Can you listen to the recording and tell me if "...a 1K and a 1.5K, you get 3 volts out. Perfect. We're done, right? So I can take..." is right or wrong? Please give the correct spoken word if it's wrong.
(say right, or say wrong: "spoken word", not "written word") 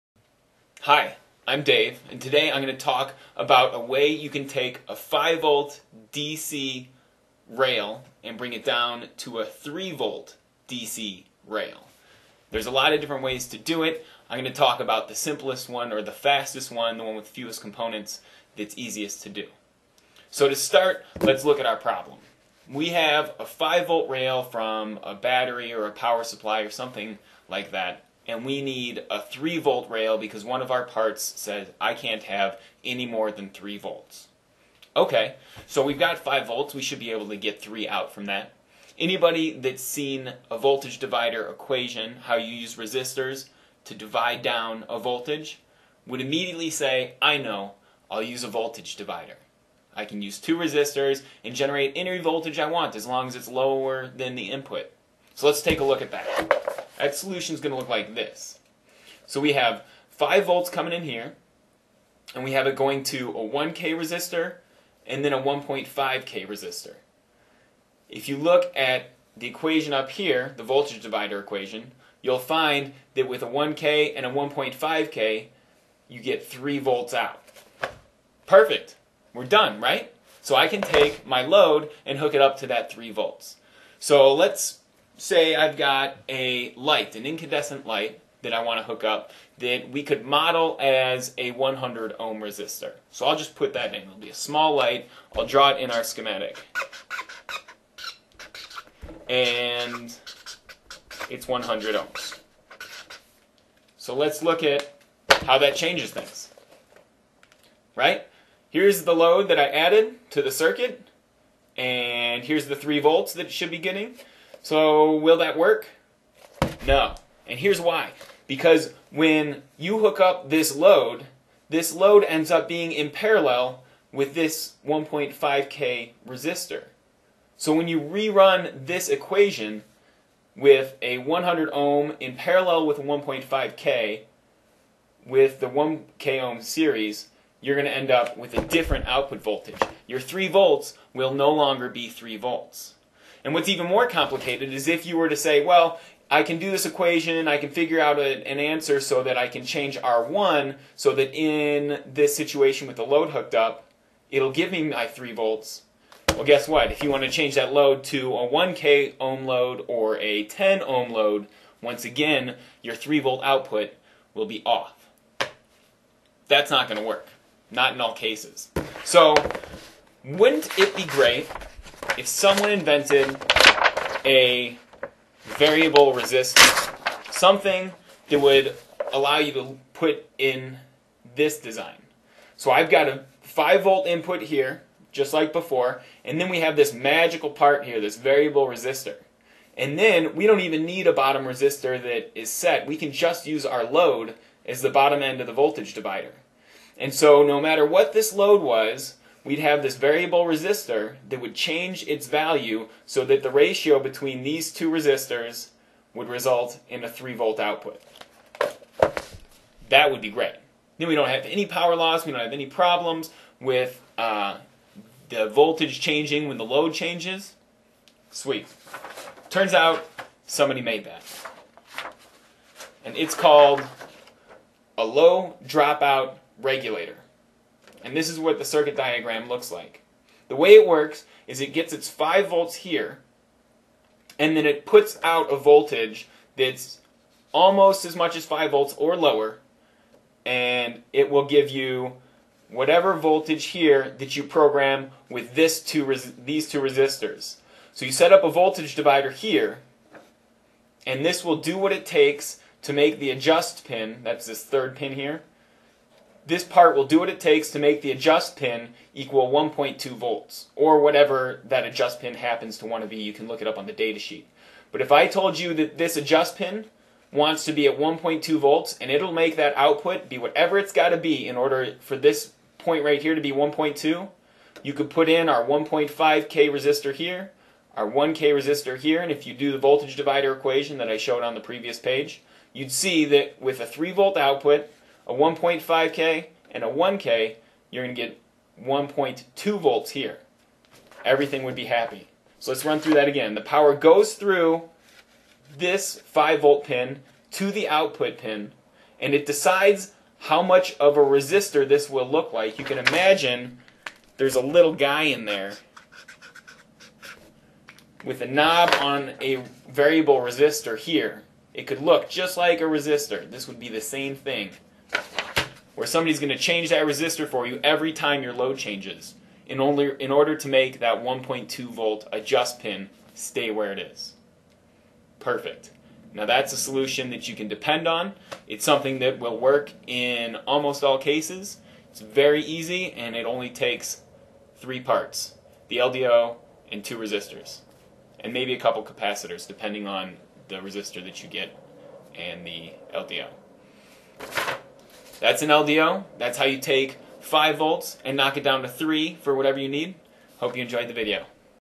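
right.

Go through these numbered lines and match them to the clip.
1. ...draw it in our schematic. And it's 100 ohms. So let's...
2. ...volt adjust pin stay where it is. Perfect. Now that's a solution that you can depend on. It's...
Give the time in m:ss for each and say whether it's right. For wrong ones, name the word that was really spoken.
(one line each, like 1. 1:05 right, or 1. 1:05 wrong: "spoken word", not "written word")
1. 1:35 right
2. 5:21 right.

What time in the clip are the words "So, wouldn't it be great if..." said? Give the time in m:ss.
2:49.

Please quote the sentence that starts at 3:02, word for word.
So I've got a 5 volt input here, just like before, and then we have this magical part here, this variable resistor.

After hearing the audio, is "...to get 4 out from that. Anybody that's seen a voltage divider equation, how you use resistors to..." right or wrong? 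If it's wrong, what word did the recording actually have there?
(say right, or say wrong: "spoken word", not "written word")
wrong: "3", not "4".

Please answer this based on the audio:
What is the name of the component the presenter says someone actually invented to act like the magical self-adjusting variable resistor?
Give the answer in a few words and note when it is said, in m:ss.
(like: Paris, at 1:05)
low dropout regulator, at 3:45.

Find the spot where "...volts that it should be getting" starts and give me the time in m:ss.
1:53.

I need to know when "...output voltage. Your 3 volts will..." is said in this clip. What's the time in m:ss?
2:19.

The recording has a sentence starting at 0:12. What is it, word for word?
There's a lot of different ways to do it.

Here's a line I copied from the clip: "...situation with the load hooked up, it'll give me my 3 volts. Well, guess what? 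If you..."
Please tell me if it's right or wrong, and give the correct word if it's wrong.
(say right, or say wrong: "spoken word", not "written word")
right.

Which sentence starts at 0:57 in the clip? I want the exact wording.
That solution is going to look like this.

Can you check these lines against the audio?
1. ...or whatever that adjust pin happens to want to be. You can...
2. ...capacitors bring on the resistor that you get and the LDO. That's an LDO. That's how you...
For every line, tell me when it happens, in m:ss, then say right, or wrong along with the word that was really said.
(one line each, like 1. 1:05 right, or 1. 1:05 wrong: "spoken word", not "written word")
1. 4:20 right
2. 5:39 wrong: "depending", not "bring".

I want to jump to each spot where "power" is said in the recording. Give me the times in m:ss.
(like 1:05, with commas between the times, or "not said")
0:25, 3:31, 4:53.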